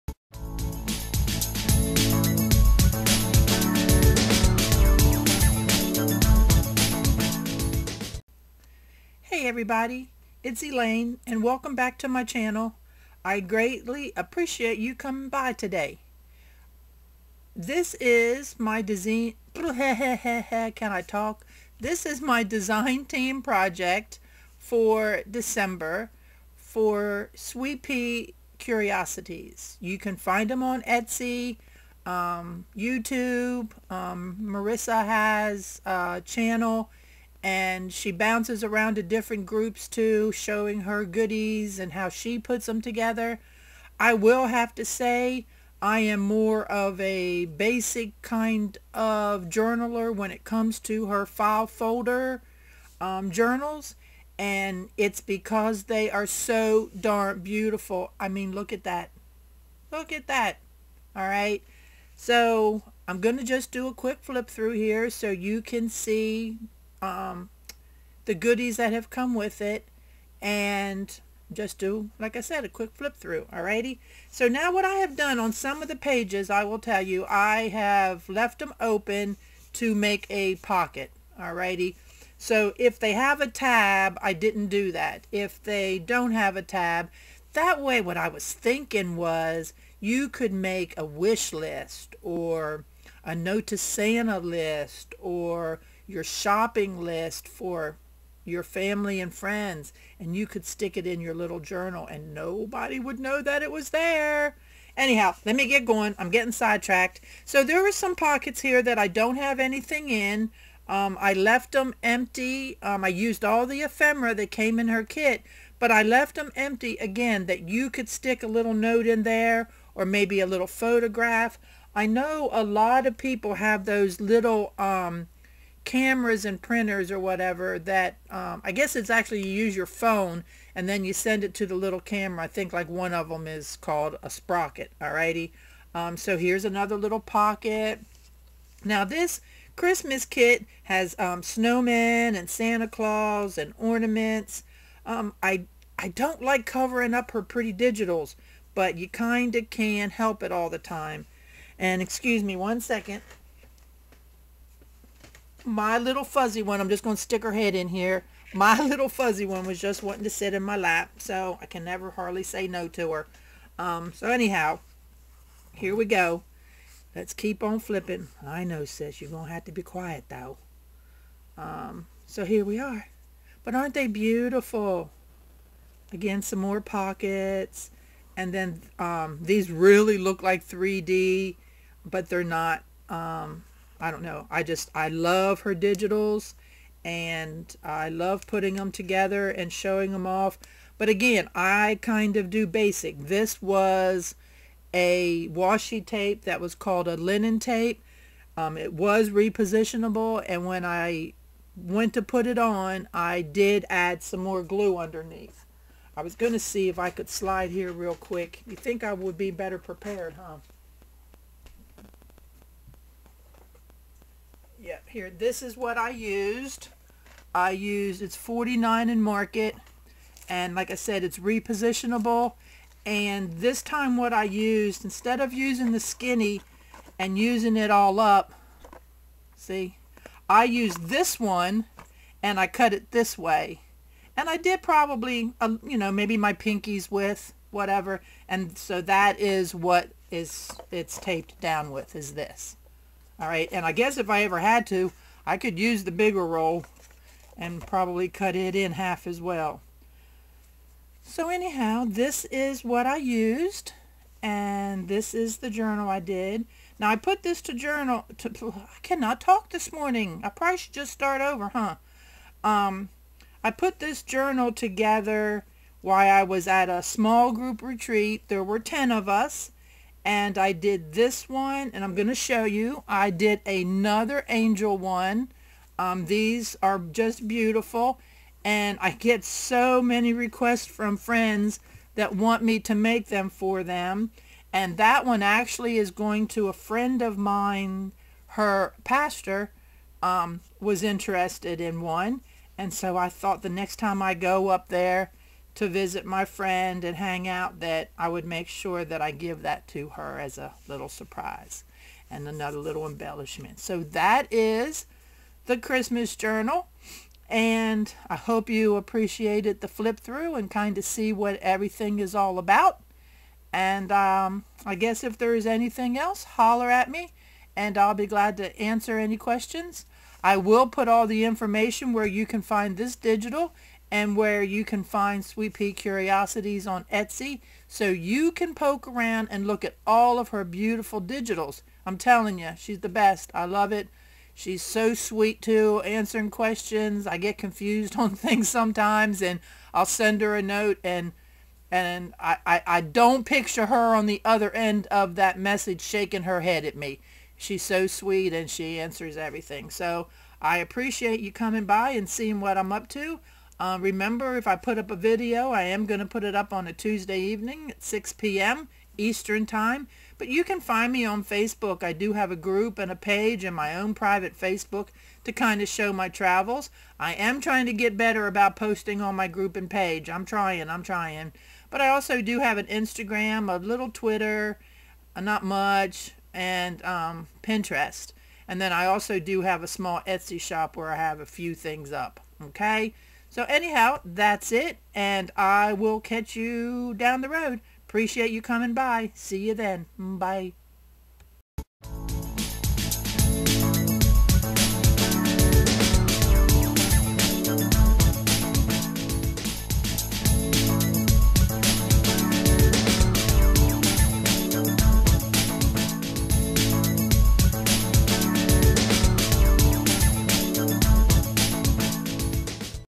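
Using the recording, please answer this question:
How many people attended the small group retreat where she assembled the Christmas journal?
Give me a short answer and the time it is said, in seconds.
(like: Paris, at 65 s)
10, at 268 s.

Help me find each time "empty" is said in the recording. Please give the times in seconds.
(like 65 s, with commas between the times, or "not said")
112 s, 116 s.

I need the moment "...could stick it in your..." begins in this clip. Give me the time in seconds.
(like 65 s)
100 s.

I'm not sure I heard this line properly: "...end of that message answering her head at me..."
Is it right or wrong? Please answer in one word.
wrong.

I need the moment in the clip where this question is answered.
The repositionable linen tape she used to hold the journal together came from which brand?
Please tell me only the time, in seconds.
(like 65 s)
218 s.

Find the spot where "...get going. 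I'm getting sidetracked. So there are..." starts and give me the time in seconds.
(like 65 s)
105 s.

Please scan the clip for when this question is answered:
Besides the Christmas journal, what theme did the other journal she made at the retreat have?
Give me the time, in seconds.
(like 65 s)
274 s.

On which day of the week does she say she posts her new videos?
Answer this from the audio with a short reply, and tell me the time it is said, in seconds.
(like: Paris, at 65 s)
Tuesday, at 356 s.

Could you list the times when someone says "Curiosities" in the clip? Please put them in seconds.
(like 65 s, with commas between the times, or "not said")
28 s, 325 s.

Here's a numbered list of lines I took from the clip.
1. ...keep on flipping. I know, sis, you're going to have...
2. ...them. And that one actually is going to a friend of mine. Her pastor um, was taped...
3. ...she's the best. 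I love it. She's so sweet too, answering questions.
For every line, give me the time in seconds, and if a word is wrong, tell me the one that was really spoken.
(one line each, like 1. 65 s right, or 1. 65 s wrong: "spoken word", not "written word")
1. 167 s right
2. 283 s wrong: "interested", not "taped"
3. 332 s right.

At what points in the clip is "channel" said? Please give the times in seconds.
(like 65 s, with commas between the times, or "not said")
12 s, 36 s.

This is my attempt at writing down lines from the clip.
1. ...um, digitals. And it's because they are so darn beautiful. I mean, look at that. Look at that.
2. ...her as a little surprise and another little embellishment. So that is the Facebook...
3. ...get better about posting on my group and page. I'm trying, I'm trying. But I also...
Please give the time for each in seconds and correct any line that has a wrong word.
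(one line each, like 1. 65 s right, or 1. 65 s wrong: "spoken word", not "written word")
1. 52 s wrong: "journals", not "digitals"
2. 300 s wrong: "Christmas", not "Facebook"
3. 367 s right.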